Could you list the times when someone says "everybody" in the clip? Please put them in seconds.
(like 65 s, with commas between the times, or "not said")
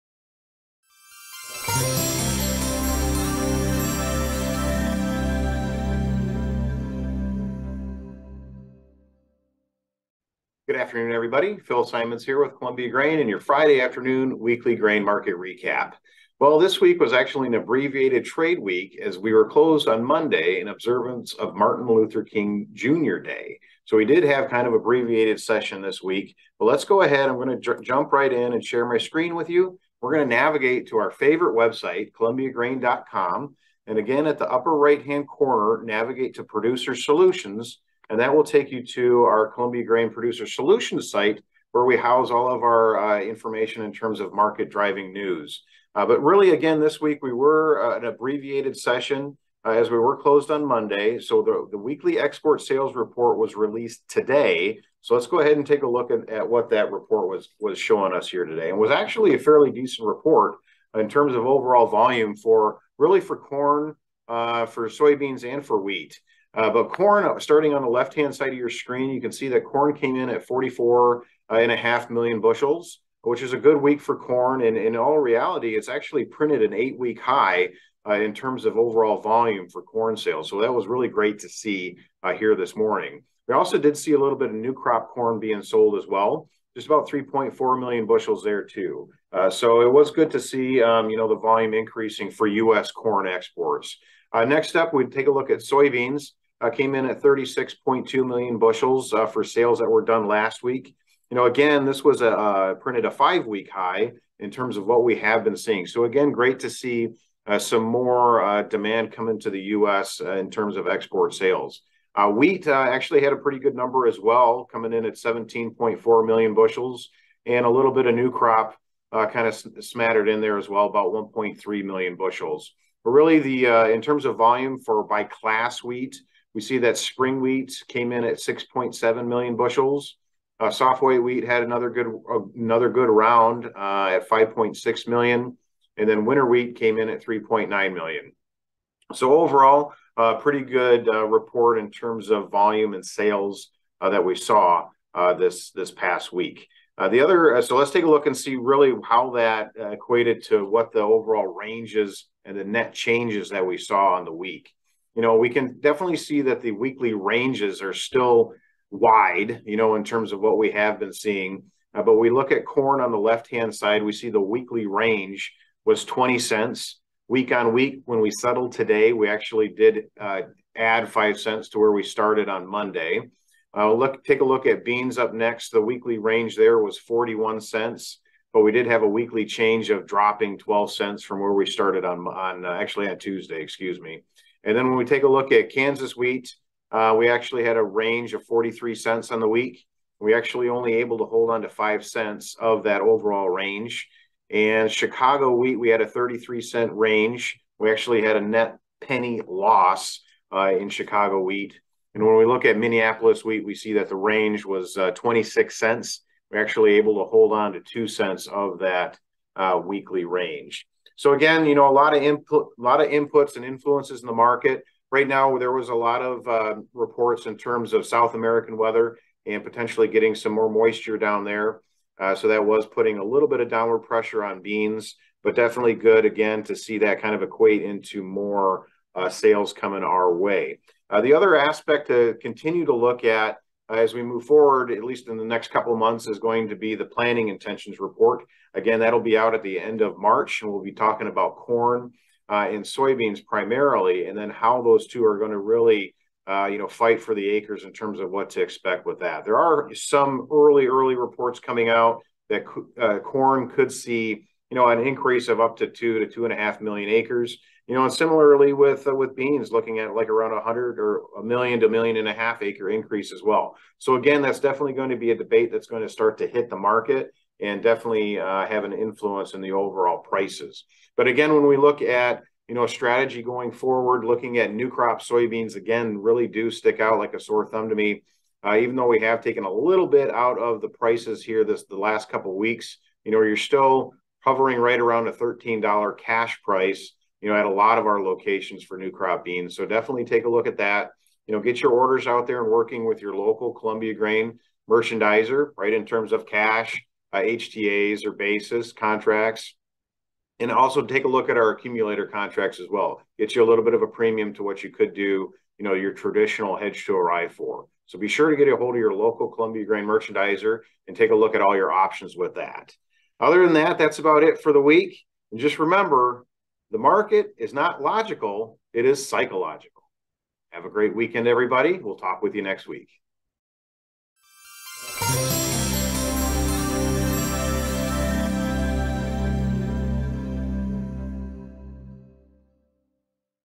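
11 s, 321 s.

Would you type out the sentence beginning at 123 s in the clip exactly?
But really, the in terms of volume for by class wheat, we see that spring wheat came in at 6.7 million bushels.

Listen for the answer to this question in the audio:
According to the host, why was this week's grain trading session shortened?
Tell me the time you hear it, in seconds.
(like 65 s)
21 s.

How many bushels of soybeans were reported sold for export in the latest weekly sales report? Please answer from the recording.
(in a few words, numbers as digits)
36.2 million bushels.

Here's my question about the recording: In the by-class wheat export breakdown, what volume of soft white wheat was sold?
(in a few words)
5.6 million.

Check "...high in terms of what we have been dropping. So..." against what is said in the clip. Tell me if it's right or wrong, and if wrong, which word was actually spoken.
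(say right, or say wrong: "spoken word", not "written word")
wrong: "seeing", not "dropping".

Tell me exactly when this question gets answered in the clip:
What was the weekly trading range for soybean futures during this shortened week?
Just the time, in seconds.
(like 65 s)
176 s.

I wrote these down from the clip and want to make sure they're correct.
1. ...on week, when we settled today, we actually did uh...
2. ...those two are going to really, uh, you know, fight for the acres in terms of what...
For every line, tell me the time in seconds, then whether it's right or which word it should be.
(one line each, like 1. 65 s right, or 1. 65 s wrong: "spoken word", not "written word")
1. 167 s right
2. 244 s right.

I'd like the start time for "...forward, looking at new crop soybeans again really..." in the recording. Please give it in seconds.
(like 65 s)
273 s.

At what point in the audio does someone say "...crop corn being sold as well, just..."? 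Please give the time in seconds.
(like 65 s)
84 s.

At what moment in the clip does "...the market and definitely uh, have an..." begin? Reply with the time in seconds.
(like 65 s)
266 s.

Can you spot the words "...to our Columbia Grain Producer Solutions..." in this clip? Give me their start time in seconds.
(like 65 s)
38 s.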